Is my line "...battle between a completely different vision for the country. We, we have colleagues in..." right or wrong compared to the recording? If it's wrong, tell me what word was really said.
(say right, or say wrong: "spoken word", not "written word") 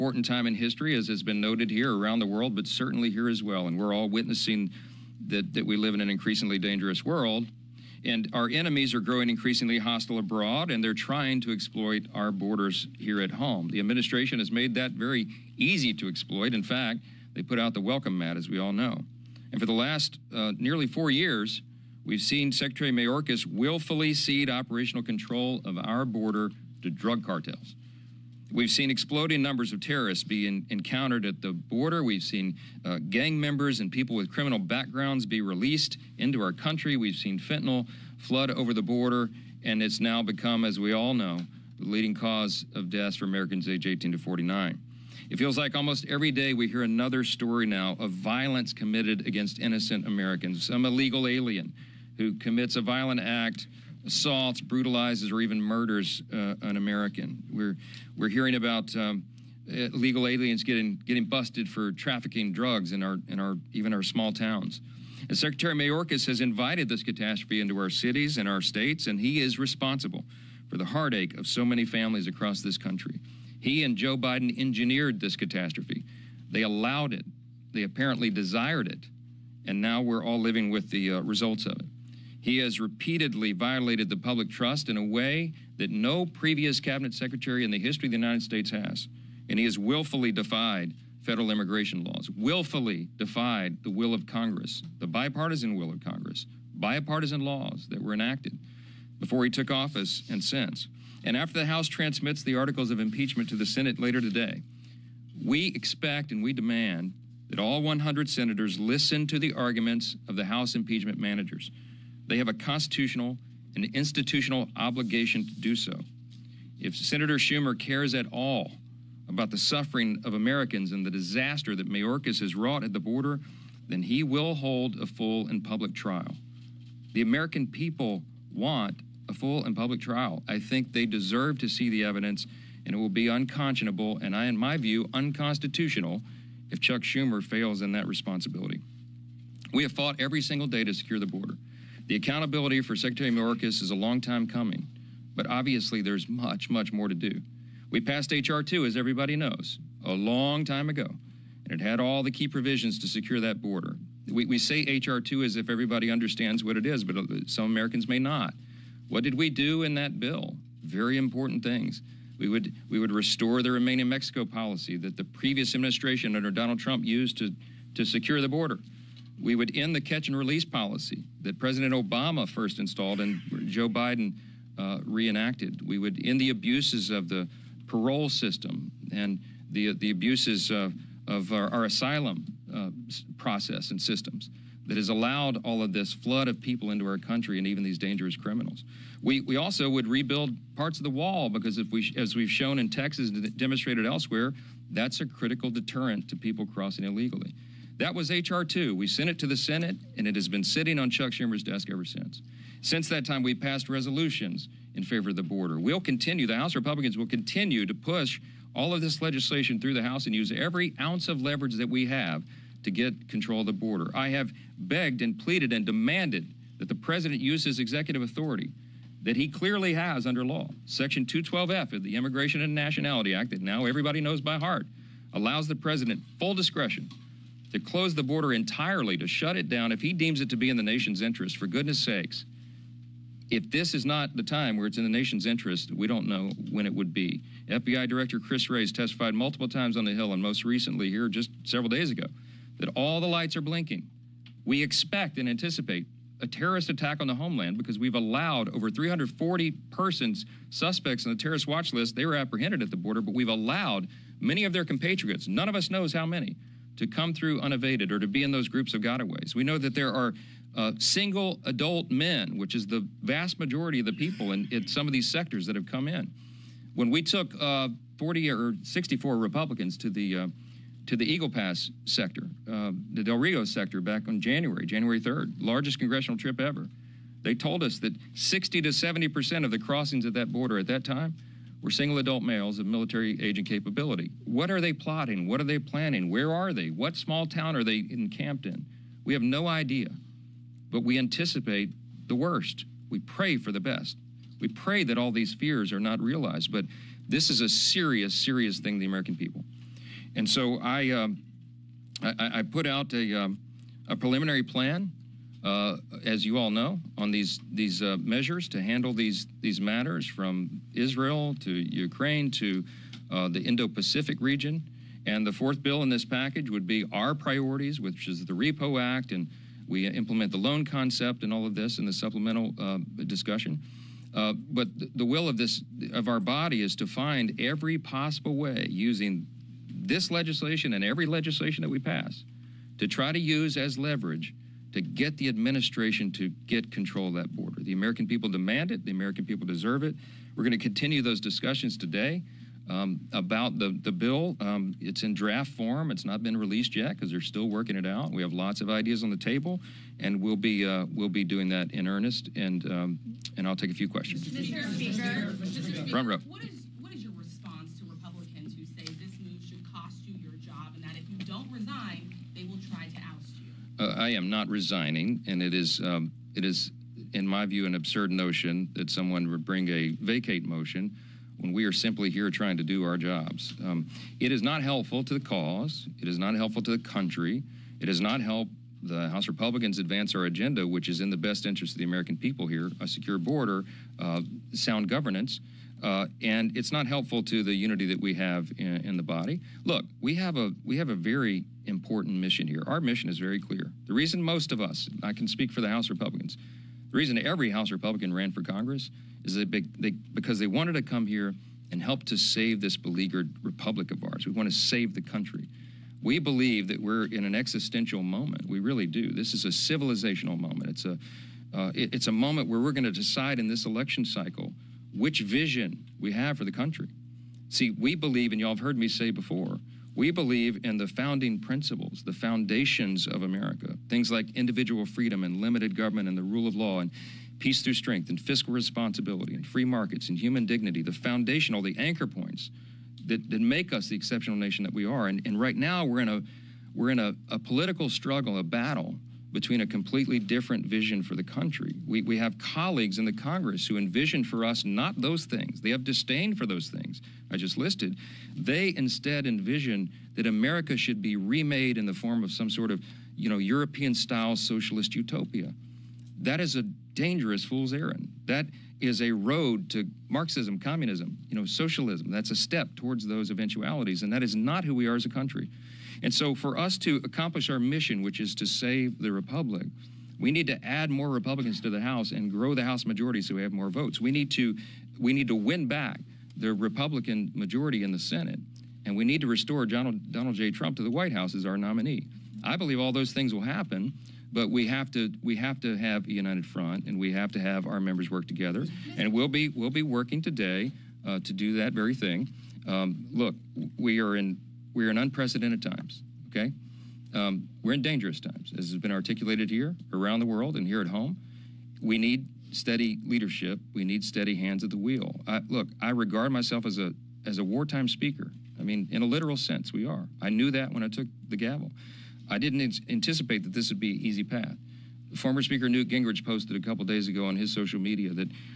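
right.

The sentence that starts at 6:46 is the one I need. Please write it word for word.
We believe that we're in an existential moment.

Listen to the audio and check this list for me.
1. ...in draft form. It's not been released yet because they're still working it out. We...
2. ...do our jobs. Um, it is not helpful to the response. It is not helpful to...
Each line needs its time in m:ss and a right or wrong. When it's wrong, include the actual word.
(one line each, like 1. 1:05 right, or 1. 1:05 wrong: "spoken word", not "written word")
1. 5:45 right
2. 6:12 wrong: "cause", not "response".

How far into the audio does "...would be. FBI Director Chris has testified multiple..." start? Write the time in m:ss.
3:56.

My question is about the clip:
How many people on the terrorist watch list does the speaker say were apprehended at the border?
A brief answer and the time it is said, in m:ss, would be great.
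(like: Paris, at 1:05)
over 340, at 4:08.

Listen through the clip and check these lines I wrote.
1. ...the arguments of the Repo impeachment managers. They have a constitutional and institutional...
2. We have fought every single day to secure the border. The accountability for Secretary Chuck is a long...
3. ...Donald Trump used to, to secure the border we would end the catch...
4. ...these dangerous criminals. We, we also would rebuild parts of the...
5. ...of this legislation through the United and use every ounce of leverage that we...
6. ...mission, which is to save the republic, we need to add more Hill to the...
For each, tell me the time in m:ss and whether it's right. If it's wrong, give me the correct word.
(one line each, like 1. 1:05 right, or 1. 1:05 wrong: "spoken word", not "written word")
1. 1:49 wrong: "House", not "Repo"
2. 2:19 wrong: "Mayorkas", not "Chuck"
3. 2:46 right
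4. 3:07 right
5. 3:28 wrong: "House", not "United"
6. 7:47 wrong: "Republicans", not "Hill".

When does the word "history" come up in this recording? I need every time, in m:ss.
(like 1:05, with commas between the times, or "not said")
0:00, 1:27.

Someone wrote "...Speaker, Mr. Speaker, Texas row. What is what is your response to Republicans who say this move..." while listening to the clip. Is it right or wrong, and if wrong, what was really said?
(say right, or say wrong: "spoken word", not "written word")
wrong: "Front", not "Texas".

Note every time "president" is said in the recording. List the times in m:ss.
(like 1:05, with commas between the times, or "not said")
2:51, 3:36, 3:45.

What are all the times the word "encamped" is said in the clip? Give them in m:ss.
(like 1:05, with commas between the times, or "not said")
4:48.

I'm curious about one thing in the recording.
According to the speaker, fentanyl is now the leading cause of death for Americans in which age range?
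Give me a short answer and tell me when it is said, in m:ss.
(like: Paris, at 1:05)
18 to 49, at 0:43.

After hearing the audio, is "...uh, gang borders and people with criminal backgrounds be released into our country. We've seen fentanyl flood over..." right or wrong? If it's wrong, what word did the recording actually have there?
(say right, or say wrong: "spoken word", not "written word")
wrong: "members", not "borders".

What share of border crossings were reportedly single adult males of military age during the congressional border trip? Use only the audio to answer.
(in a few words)
60 to 70 percent.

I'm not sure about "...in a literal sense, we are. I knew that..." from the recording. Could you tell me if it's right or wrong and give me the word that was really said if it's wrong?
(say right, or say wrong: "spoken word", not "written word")
right.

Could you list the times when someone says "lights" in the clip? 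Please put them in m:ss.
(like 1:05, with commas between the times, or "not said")
4:03.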